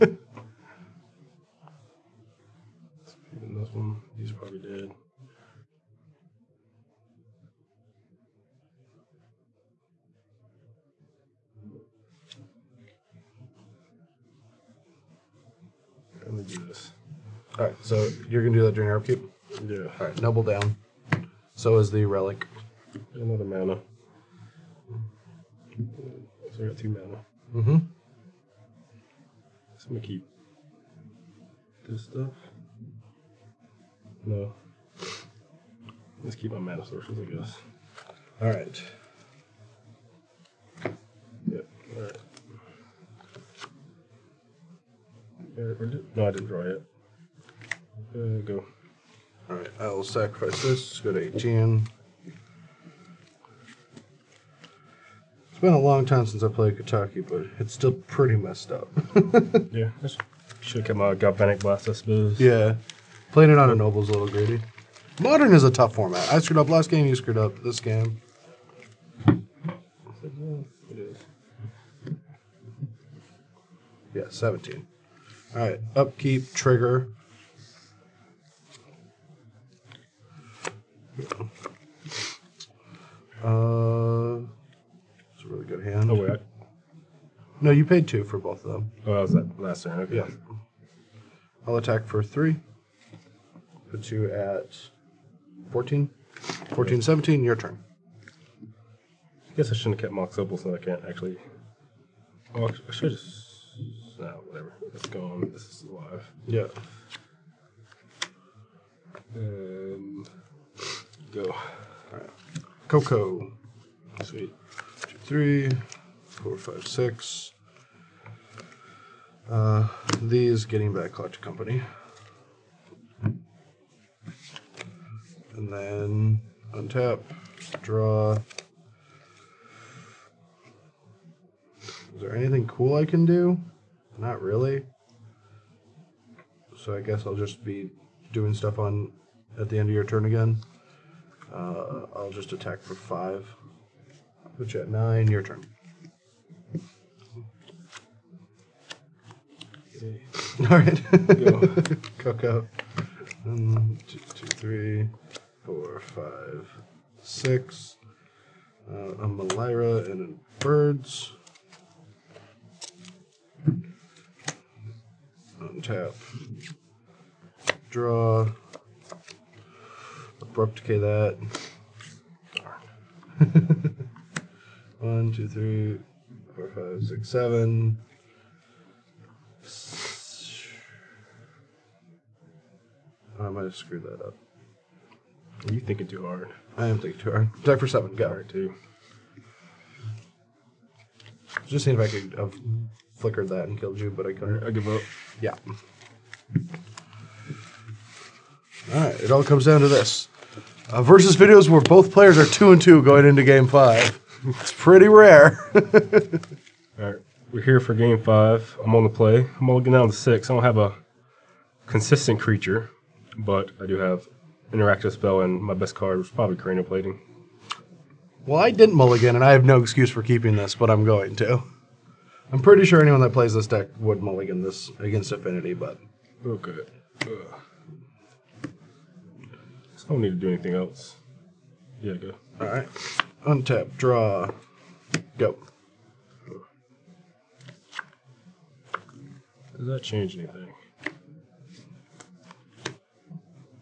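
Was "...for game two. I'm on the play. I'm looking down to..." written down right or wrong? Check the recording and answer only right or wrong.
wrong.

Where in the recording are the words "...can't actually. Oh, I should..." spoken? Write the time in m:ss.
1:40.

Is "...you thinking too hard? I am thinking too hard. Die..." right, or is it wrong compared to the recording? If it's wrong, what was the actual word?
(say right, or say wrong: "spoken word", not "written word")
right.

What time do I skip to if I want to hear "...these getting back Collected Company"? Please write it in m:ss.
2:00.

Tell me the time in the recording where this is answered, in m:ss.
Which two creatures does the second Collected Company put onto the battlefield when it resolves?
2:38.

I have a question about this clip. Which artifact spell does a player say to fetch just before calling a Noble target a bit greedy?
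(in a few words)
Galvanic Blast.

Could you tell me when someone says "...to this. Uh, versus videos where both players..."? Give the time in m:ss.
3:19.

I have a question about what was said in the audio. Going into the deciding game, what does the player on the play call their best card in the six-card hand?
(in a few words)
Cranial Plating.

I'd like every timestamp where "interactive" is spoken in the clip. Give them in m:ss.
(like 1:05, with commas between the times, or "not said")
3:34.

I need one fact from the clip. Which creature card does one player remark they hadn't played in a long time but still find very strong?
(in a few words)
Kataki.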